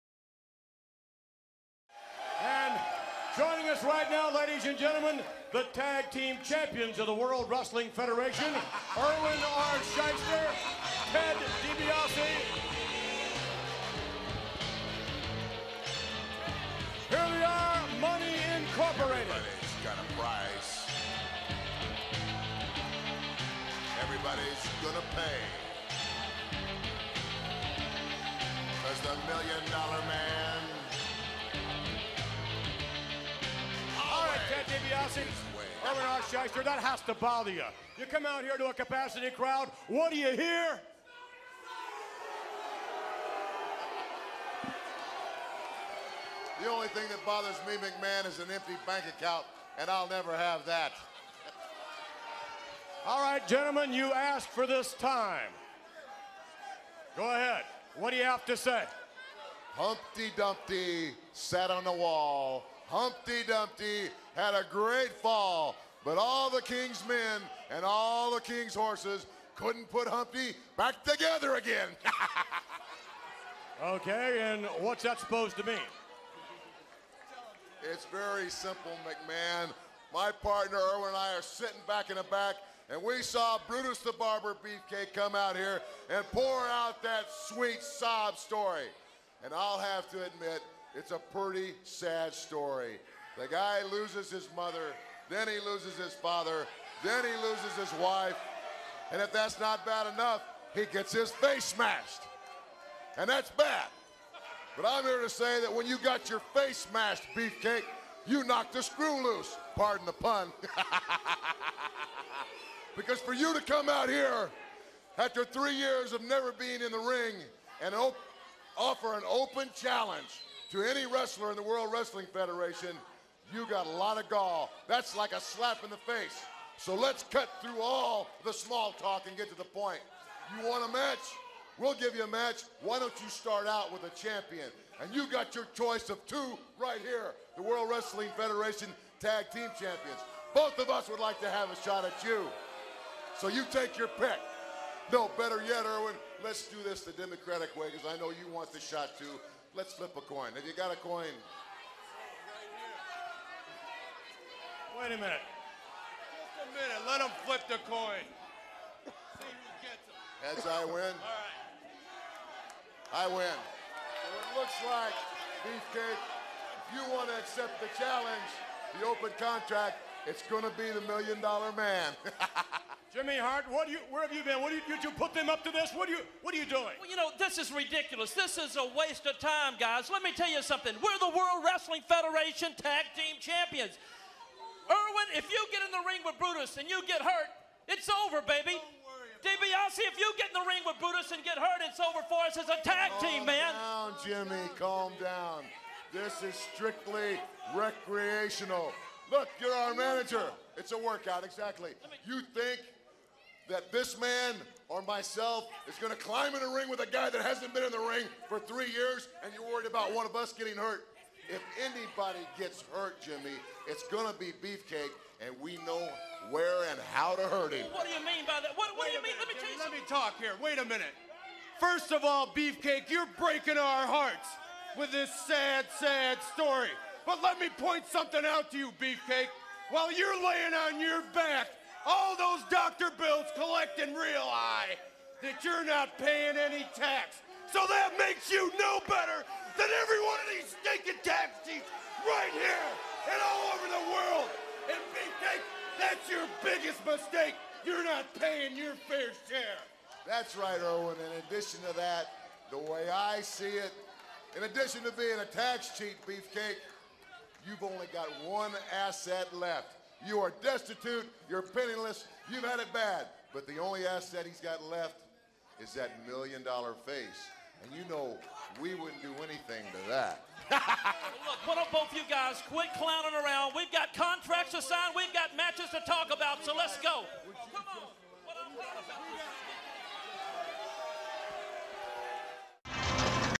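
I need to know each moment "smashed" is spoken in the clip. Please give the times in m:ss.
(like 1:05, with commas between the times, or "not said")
1:41, 1:46.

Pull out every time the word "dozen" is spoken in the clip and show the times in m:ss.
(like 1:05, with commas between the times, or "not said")
not said.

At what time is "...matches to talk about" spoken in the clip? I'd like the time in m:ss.
4:35.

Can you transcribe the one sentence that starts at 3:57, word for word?
So that makes you no better than every one of these stinking tax cheats right here and all over the world.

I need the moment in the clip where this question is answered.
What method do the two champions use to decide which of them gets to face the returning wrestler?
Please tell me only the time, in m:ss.
2:29.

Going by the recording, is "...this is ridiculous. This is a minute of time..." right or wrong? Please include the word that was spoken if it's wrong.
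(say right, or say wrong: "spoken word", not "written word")
wrong: "waste", not "minute".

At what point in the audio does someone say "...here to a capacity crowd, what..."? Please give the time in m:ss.
0:38.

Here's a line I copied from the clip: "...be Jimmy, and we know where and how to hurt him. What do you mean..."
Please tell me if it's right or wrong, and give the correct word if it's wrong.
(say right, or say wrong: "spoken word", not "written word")
wrong: "Beefcake", not "Jimmy".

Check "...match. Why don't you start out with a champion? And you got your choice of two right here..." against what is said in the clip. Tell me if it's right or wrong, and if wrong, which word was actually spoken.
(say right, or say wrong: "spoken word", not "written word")
right.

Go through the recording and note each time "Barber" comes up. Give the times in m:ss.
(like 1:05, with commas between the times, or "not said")
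1:24.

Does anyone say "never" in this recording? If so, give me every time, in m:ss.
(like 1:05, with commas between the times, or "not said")
0:50, 1:56.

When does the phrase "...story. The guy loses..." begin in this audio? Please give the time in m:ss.
1:32.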